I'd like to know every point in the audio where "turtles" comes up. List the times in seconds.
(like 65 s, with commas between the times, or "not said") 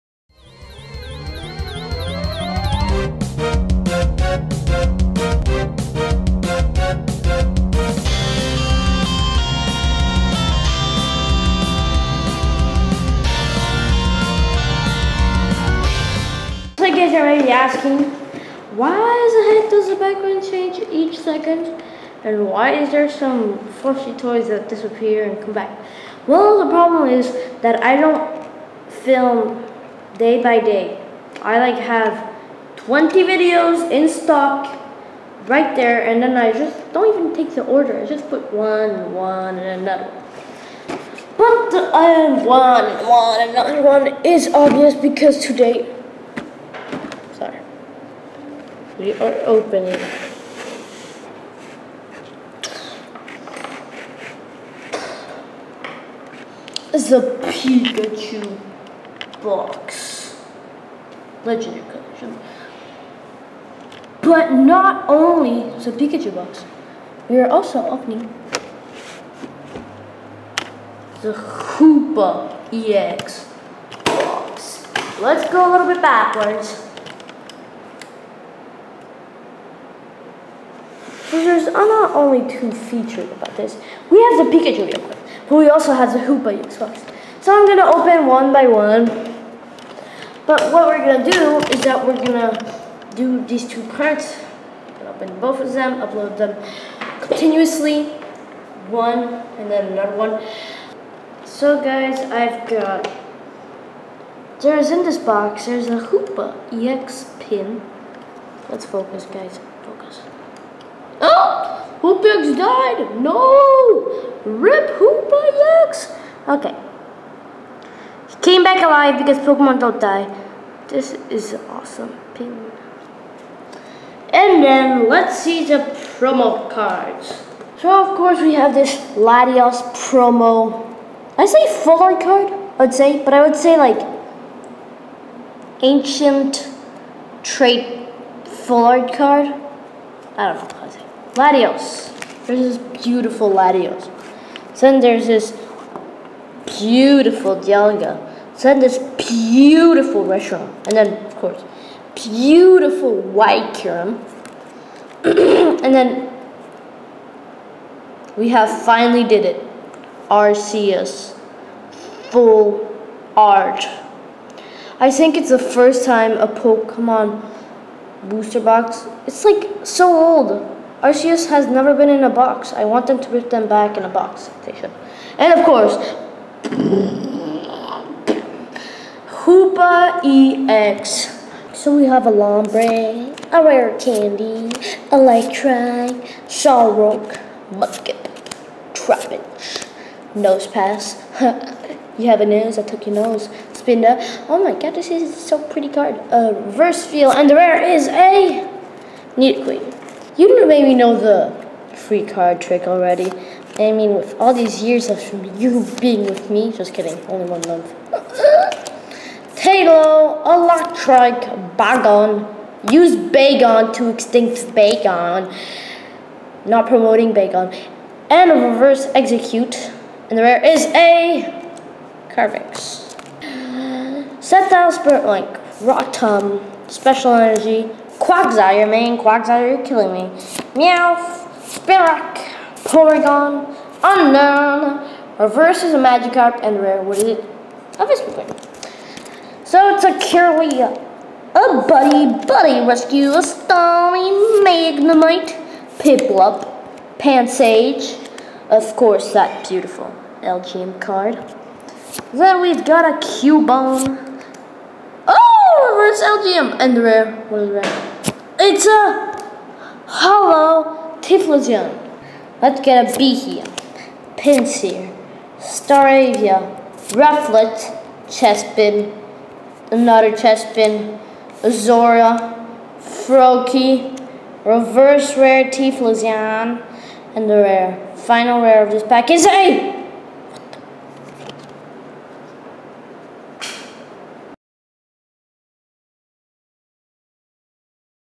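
not said.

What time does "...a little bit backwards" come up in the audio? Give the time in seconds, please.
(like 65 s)
75 s.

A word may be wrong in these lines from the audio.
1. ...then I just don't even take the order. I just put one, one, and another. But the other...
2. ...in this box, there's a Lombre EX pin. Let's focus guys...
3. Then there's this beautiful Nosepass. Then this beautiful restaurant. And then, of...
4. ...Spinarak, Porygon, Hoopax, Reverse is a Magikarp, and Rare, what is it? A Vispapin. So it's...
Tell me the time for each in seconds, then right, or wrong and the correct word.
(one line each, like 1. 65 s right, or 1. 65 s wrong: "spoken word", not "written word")
1. 36 s right
2. 104 s wrong: "Hoopa", not "Lombre"
3. 144 s wrong: "Dialga", not "Nosepass"
4. 231 s wrong: "Unknown", not "Hoopax".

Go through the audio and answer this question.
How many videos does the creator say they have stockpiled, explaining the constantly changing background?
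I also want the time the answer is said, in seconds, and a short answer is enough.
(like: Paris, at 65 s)
20, at 32 s.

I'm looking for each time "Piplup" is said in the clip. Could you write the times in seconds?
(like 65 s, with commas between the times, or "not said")
245 s.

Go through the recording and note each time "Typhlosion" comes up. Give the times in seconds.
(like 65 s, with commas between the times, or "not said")
261 s, 275 s.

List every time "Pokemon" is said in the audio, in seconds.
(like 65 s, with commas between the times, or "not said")
119 s, 166 s.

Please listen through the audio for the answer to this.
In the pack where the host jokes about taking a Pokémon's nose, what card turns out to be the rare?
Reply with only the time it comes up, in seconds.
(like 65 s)
199 s.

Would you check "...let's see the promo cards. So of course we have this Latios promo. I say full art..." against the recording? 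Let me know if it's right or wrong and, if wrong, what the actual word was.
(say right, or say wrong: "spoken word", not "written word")
right.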